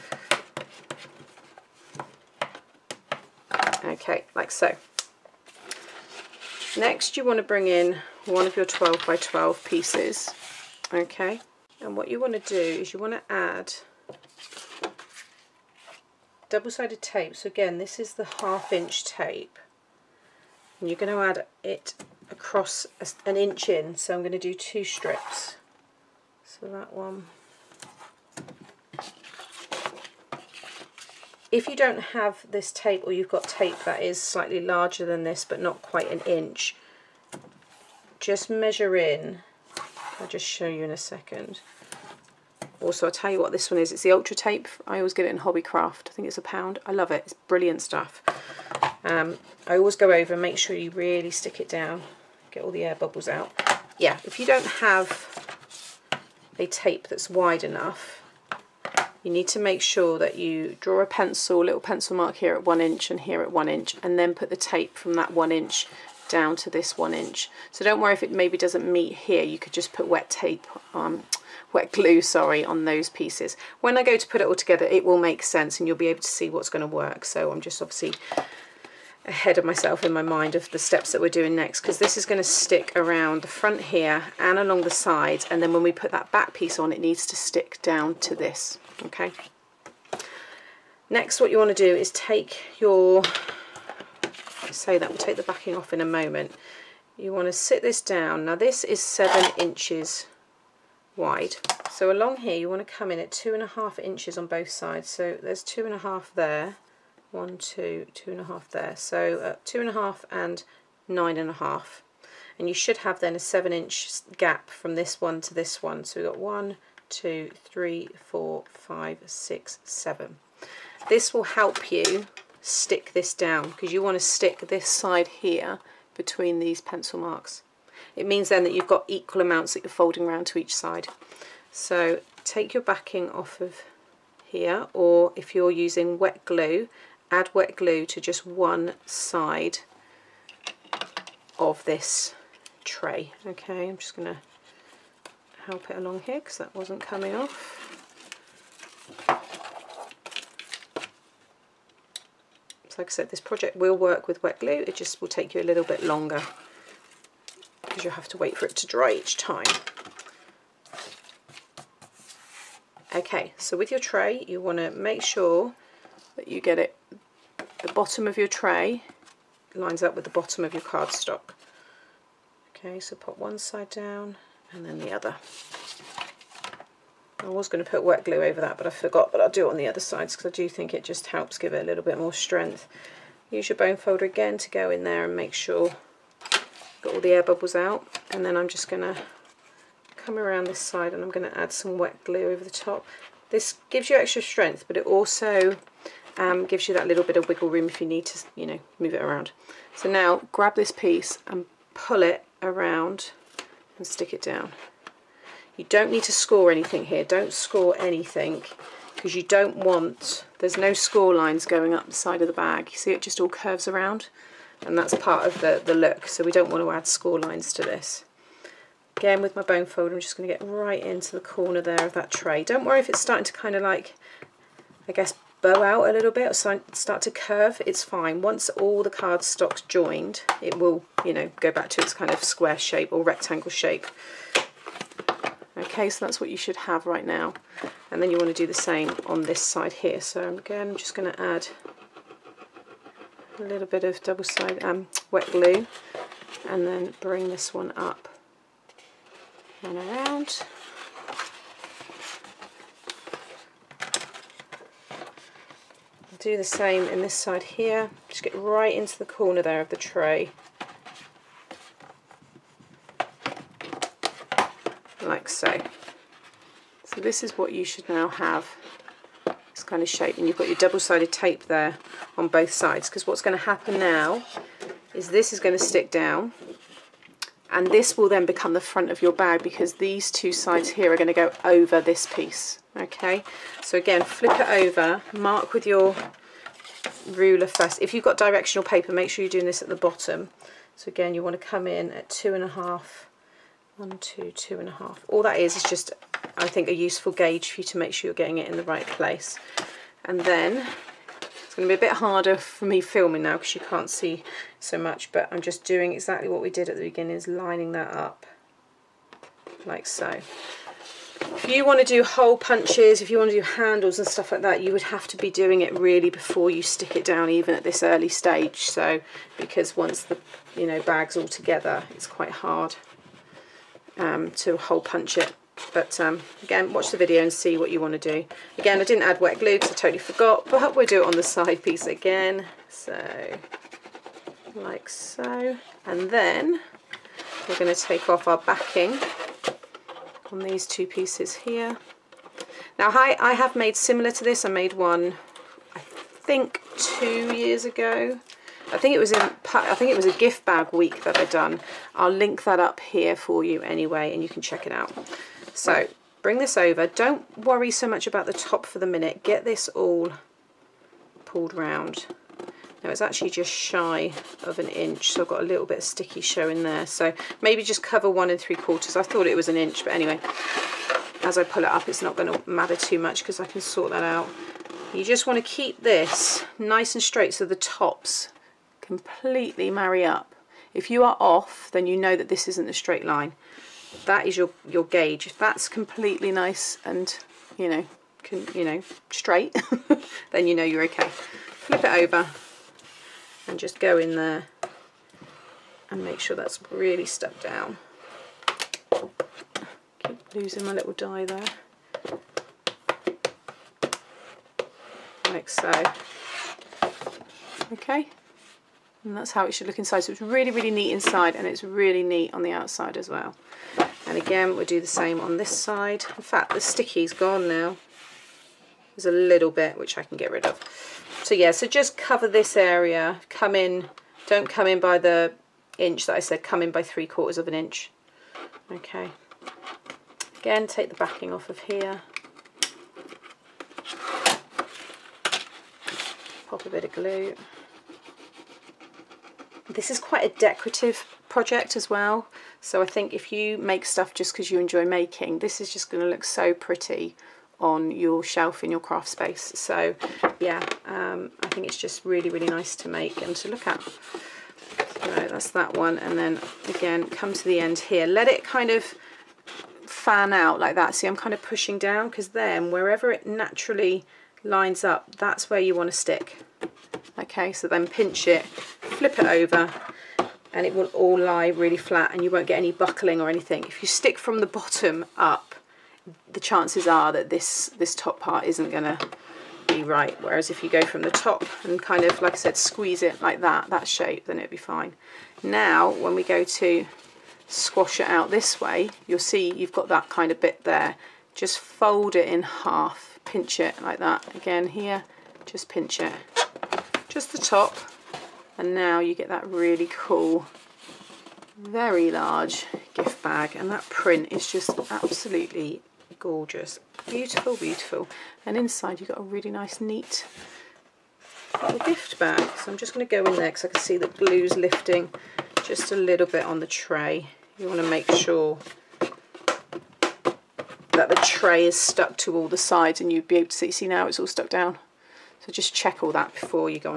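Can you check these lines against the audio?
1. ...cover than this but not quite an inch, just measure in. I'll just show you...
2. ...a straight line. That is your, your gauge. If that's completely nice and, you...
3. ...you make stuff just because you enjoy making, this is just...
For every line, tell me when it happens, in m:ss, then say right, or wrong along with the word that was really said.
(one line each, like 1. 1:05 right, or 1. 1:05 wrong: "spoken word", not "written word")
1. 0:34 wrong: "larger", not "cover"
2. 6:22 right
3. 7:23 right.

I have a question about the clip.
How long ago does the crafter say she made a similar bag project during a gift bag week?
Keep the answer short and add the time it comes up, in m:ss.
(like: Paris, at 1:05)
2 years, at 5:46.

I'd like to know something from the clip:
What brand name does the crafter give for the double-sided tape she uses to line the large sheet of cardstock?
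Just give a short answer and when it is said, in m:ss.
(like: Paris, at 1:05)
Ultra Tape, at 0:44.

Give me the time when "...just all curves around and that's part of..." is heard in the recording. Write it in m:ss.
3:33.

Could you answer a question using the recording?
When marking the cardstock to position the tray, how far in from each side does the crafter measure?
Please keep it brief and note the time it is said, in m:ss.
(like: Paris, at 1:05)
2.5 inches, at 1:43.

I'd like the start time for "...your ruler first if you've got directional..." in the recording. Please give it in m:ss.
4:45.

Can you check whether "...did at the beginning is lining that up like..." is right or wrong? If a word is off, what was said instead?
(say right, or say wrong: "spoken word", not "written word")
right.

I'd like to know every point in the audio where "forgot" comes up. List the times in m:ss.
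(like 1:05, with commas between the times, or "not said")
2:58, 5:30.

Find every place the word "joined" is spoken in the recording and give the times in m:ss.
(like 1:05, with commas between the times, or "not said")
3:49.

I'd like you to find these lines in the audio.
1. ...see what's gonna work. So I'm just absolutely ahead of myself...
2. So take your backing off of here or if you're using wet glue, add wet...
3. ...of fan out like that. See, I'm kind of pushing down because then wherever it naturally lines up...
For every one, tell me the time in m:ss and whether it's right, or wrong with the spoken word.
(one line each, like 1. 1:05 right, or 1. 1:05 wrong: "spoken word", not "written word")
1. 1:16 wrong: "obviously", not "absolutely"
2. 2:11 right
3. 7:38 right.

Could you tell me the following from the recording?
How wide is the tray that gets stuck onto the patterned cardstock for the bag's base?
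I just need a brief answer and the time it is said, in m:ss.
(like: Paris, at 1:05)
7 inches, at 1:39.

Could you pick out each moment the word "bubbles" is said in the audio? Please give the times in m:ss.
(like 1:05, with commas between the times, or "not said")
0:52, 3:07.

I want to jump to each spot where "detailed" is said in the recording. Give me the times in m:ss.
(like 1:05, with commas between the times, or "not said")
not said.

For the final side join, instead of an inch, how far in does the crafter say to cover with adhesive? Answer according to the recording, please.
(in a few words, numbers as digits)
three quarters of an inch.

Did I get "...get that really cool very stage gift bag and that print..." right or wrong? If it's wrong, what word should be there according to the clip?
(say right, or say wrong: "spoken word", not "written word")
wrong: "large", not "stage".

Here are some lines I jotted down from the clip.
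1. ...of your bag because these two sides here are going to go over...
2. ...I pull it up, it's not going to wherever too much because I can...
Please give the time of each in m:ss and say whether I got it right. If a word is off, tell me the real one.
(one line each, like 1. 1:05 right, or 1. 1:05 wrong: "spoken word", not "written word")
1. 4:39 right
2. 6:11 wrong: "matter", not "wherever".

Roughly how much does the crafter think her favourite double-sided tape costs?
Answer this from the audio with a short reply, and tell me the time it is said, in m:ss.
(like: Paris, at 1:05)
a pound, at 0:46.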